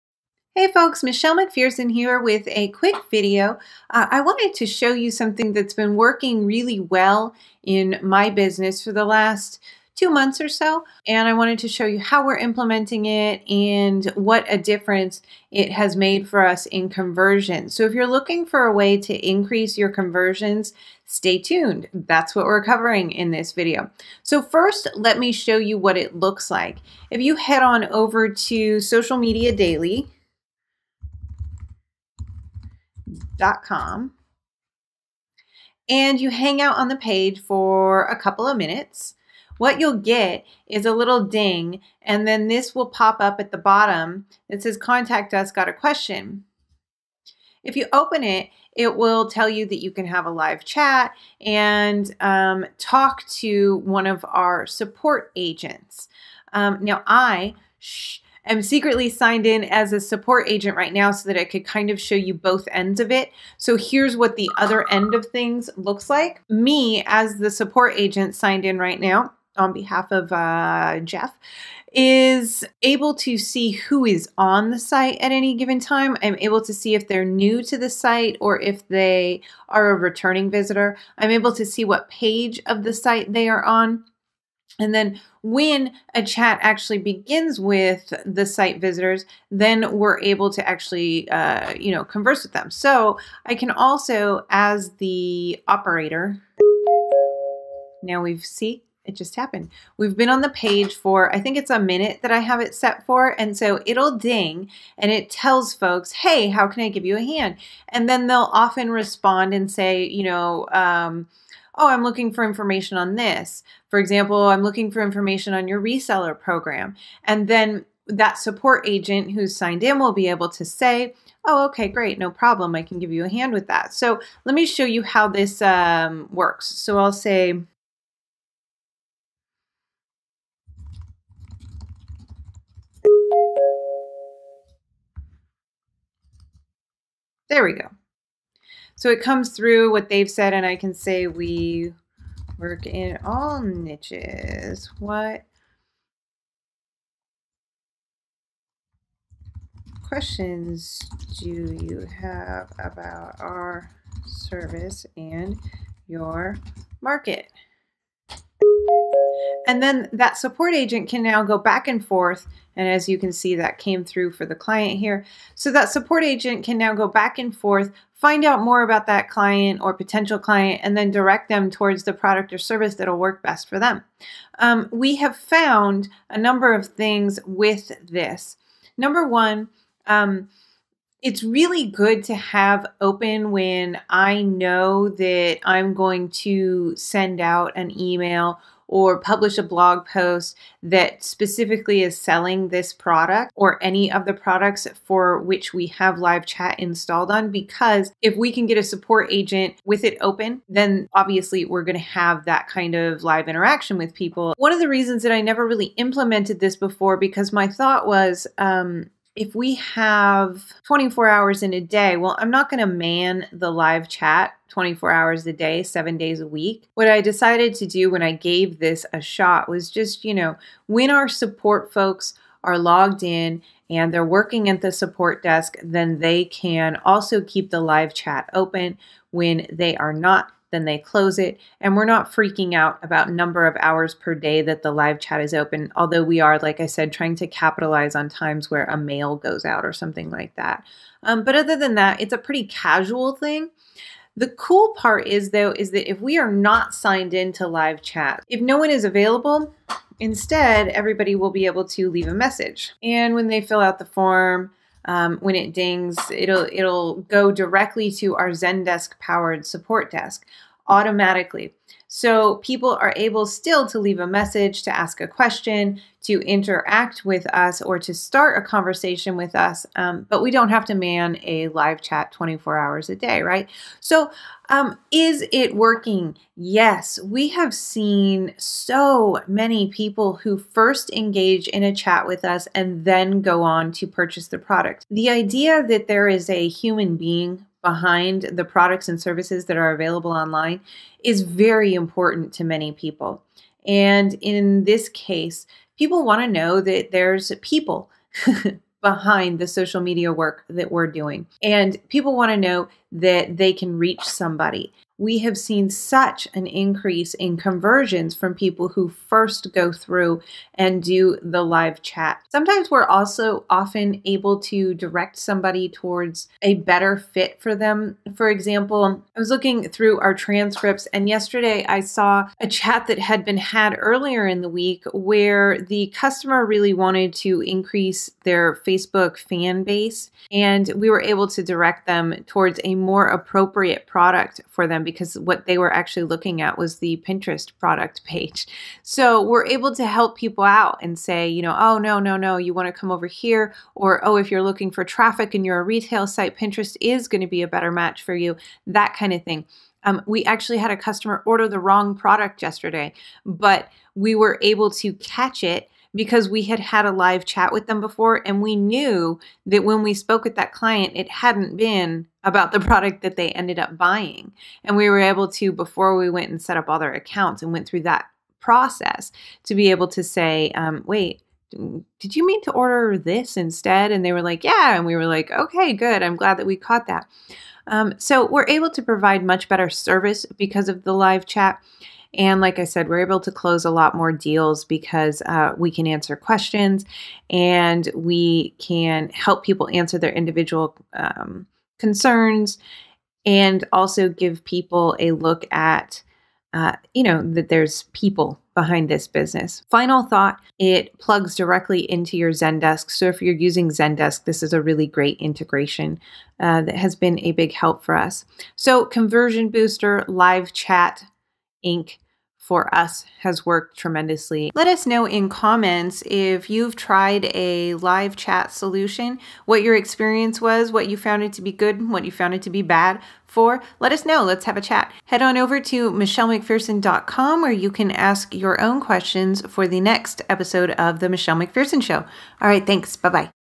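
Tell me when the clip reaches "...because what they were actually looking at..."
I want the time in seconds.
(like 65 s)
335 s.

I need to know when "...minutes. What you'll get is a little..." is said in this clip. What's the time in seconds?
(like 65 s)
38 s.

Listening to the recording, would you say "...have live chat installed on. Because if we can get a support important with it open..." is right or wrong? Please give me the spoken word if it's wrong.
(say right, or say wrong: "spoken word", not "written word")
wrong: "agent", not "important".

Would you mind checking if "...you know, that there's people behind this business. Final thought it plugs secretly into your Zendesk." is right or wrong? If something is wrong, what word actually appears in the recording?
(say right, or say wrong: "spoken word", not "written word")
wrong: "directly", not "secretly".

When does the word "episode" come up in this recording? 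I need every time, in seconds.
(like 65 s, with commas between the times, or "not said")
430 s.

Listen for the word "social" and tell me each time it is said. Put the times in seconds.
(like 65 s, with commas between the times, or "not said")
28 s, 299 s.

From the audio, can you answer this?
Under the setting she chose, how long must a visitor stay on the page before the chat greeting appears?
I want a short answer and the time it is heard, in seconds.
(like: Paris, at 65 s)
a minute, at 101 s.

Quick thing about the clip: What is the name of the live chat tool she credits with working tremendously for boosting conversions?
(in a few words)
Conversion Booster.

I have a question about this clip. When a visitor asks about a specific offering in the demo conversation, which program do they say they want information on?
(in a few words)
reseller program.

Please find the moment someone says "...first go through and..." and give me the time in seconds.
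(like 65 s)
309 s.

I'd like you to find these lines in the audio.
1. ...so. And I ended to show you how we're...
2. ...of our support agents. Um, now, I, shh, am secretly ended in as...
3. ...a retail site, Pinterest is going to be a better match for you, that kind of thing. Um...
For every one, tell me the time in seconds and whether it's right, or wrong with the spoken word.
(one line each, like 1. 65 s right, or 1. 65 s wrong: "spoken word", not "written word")
1. 10 s wrong: "wanted", not "ended"
2. 54 s wrong: "signed", not "ended"
3. 345 s right.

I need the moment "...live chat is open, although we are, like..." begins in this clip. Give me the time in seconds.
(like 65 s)
234 s.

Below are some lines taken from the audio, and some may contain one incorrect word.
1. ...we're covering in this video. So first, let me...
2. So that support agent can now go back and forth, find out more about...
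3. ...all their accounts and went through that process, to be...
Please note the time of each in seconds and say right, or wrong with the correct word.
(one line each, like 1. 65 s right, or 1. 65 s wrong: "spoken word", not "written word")
1. 22 s right
2. 165 s right
3. 366 s right.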